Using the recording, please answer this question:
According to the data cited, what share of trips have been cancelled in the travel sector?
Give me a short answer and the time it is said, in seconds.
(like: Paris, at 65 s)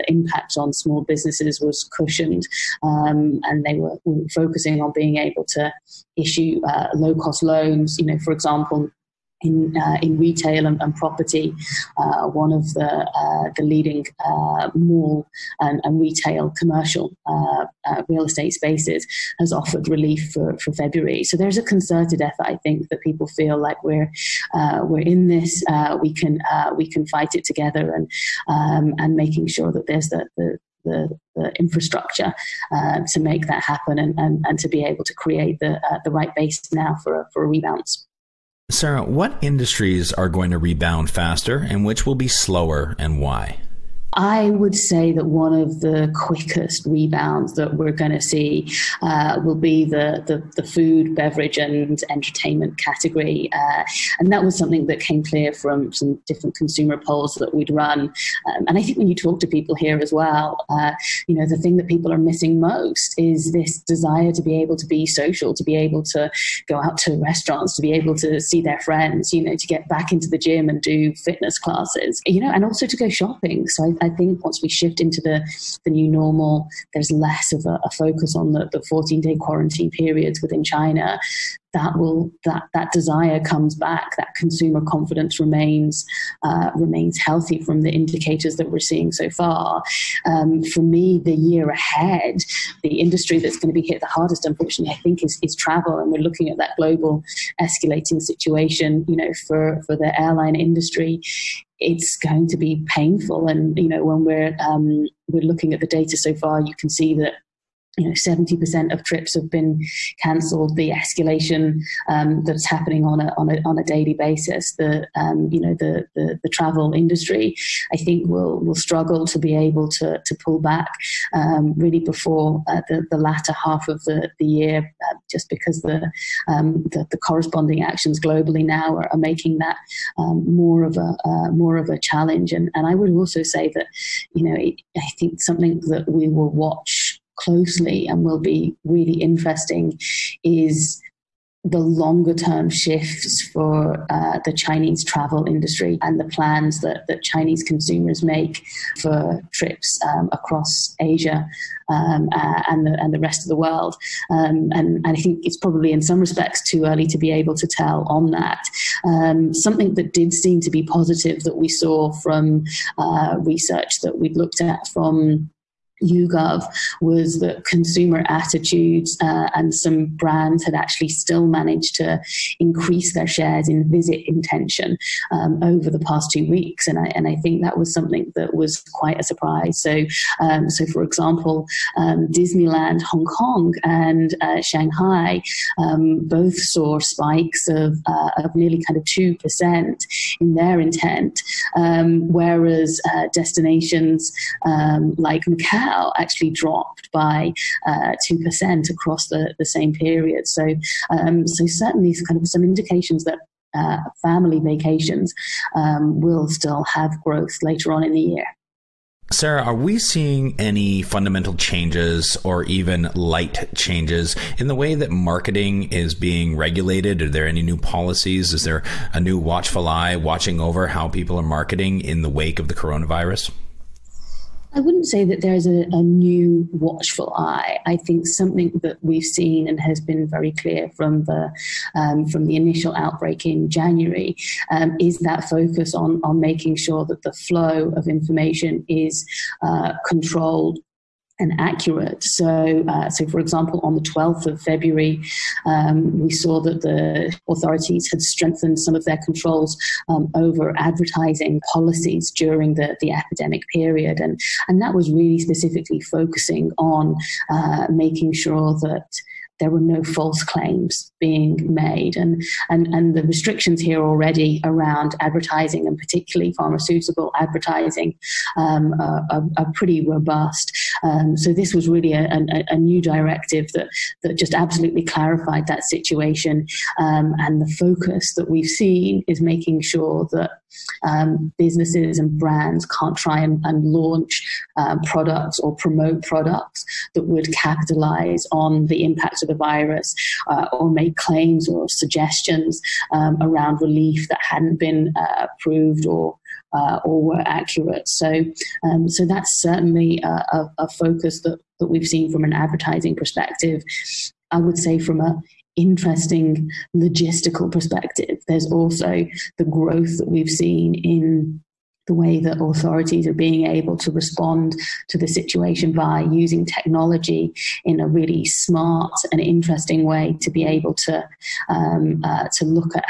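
70%, at 108 s.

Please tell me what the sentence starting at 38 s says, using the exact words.
Sarah, what industries are going to rebound faster and which will be slower and why?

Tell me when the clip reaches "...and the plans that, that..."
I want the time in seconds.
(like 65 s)
146 s.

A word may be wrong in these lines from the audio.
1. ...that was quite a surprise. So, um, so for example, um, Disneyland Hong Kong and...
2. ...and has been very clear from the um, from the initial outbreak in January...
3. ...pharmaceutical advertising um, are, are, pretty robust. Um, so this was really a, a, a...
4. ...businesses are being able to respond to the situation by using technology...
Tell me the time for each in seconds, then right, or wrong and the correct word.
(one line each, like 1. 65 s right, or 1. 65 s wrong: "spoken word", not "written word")
1. 178 s right
2. 229 s right
3. 266 s right
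4. 312 s wrong: "authorities", not "businesses".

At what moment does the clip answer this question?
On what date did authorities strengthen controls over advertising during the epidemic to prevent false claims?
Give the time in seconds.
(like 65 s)
244 s.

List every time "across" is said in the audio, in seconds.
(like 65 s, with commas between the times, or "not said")
150 s, 198 s.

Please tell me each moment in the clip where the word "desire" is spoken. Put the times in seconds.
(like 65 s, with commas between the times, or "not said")
63 s, 82 s.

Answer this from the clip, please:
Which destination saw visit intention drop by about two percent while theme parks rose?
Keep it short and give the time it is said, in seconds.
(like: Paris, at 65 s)
Macau, at 195 s.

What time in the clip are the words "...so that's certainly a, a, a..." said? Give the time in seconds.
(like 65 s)
299 s.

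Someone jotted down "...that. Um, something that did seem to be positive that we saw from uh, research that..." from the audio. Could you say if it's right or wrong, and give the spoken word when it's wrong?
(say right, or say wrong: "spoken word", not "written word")
right.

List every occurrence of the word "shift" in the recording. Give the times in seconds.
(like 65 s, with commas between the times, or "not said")
74 s, 142 s.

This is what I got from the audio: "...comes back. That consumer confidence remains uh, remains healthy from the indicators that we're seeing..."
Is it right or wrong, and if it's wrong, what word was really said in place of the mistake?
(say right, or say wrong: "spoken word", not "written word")
right.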